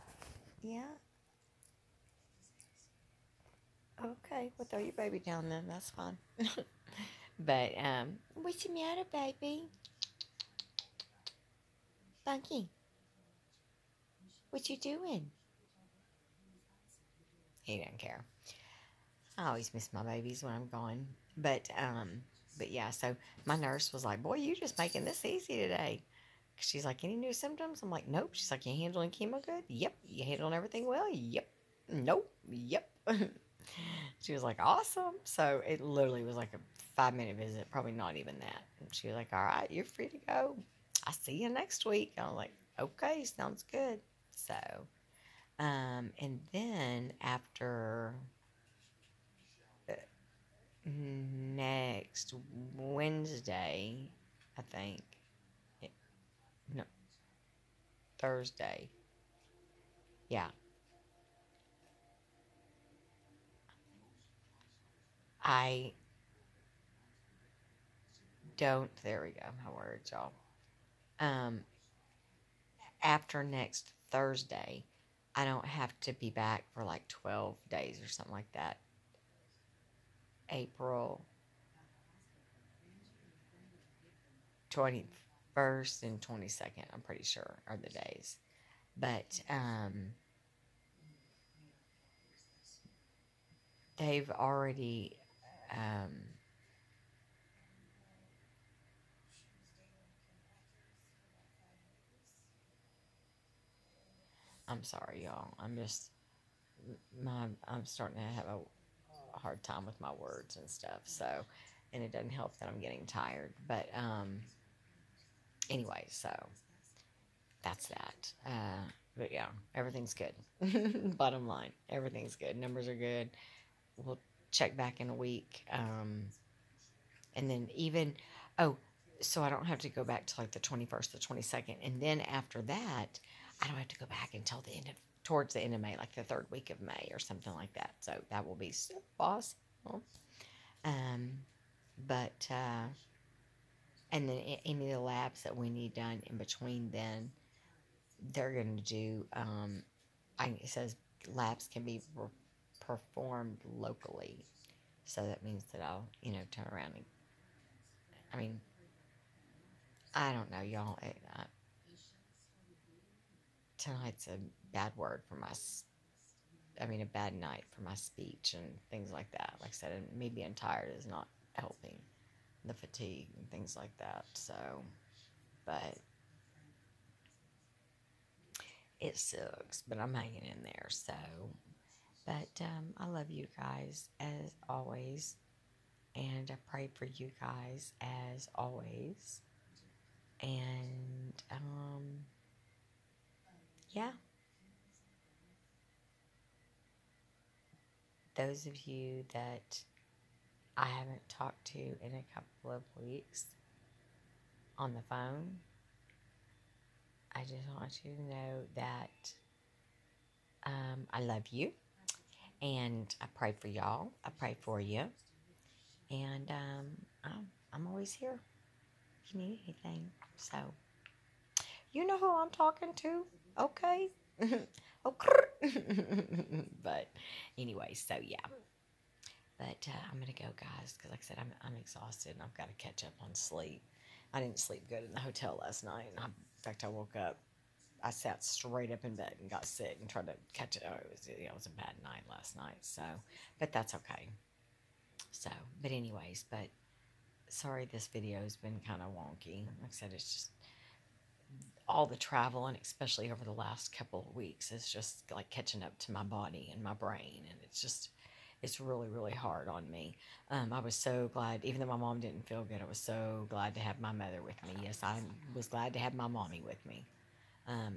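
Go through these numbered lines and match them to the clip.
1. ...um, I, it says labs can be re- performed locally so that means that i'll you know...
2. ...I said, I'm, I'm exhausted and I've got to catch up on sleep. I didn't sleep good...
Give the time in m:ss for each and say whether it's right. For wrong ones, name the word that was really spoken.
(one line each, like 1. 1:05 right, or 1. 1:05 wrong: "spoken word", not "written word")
1. 2:29 right
2. 3:51 right.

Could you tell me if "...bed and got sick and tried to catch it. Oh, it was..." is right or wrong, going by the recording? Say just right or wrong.
right.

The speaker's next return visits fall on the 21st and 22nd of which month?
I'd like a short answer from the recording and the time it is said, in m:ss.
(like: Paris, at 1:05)
April, at 1:20.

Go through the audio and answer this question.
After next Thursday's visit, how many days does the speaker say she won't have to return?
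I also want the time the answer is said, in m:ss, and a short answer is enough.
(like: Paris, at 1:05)
12 days, at 1:17.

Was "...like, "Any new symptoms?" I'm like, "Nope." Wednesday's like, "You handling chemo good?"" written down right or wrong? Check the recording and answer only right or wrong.
wrong.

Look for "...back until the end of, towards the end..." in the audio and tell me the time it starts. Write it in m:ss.
2:14.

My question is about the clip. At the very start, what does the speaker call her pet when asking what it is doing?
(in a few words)
Bunky.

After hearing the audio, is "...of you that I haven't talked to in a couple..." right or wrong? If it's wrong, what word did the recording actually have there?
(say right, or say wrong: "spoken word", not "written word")
right.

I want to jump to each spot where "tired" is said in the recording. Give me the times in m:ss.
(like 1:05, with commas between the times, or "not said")
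1:53, 2:50.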